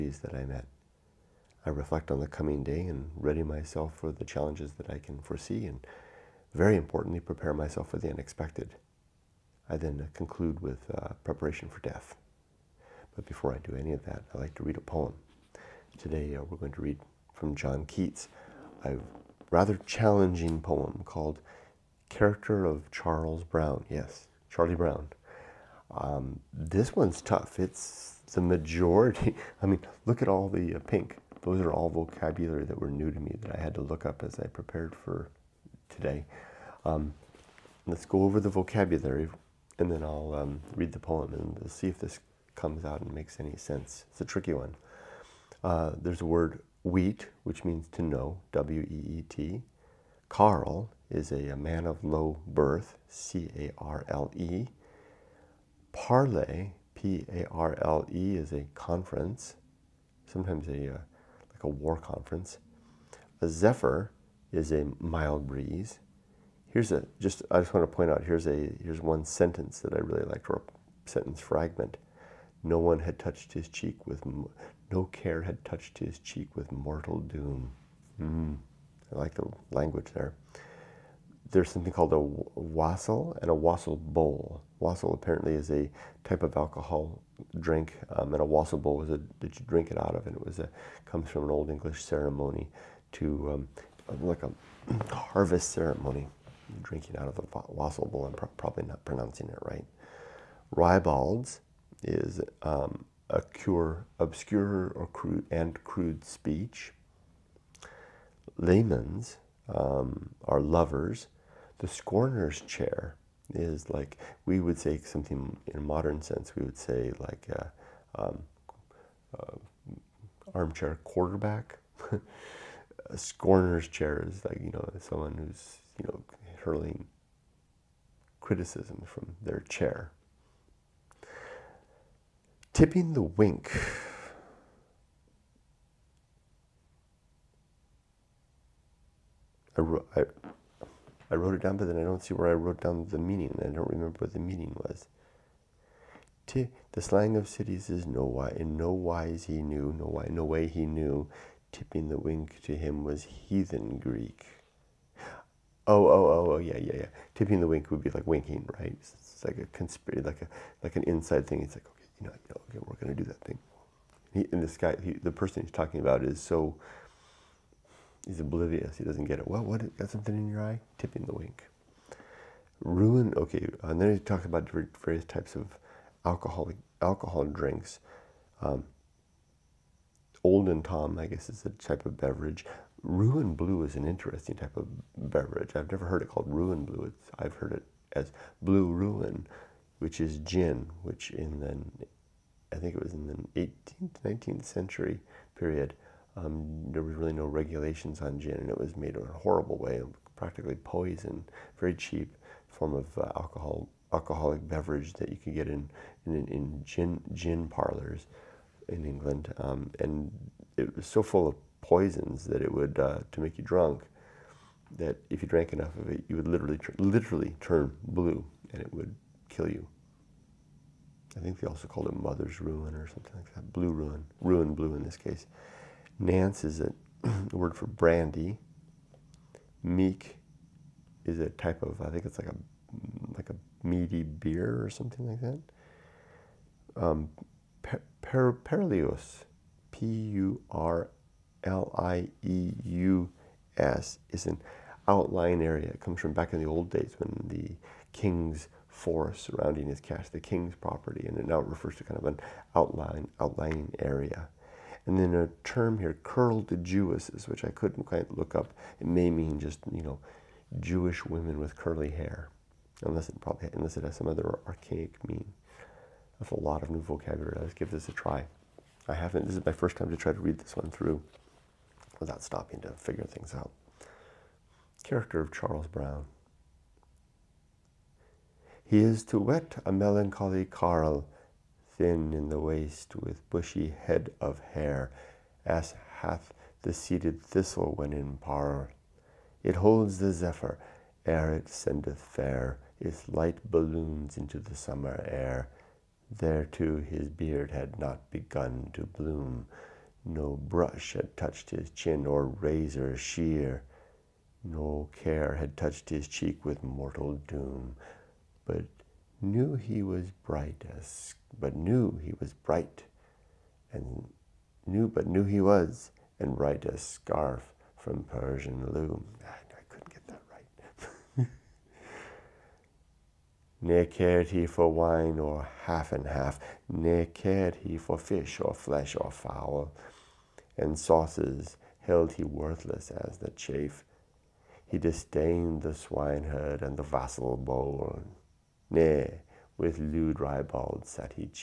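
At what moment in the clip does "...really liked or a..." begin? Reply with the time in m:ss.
1:09.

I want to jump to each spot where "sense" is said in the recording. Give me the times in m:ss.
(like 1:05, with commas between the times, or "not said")
0:43, 1:56.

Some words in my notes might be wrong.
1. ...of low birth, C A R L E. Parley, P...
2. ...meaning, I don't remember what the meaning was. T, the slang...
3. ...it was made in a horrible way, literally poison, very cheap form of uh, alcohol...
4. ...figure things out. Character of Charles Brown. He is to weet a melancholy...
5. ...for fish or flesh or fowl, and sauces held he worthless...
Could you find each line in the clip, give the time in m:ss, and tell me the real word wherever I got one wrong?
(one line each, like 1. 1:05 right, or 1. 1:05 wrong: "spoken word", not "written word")
1. 0:51 right
2. 2:23 right
3. 3:18 wrong: "practically", not "literally"
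4. 4:32 right
5. 5:27 right.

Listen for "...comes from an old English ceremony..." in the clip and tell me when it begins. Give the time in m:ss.
1:31.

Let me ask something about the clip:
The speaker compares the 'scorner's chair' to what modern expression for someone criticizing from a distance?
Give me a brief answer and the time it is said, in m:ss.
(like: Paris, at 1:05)
armchair quarterback, at 2:00.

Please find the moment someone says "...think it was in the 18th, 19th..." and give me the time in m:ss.
3:12.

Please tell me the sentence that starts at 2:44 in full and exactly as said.
He, and this guy, he, the person he's talking about, is so He's oblivious.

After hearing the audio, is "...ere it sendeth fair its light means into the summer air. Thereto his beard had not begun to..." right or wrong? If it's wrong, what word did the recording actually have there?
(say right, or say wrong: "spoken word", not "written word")
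wrong: "balloons", not "means".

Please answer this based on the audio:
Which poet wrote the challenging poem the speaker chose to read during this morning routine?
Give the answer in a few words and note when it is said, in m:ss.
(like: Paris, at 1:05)
John Keats, at 0:17.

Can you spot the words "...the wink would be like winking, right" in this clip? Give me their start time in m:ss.
2:37.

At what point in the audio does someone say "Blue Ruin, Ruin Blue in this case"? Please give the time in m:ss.
3:43.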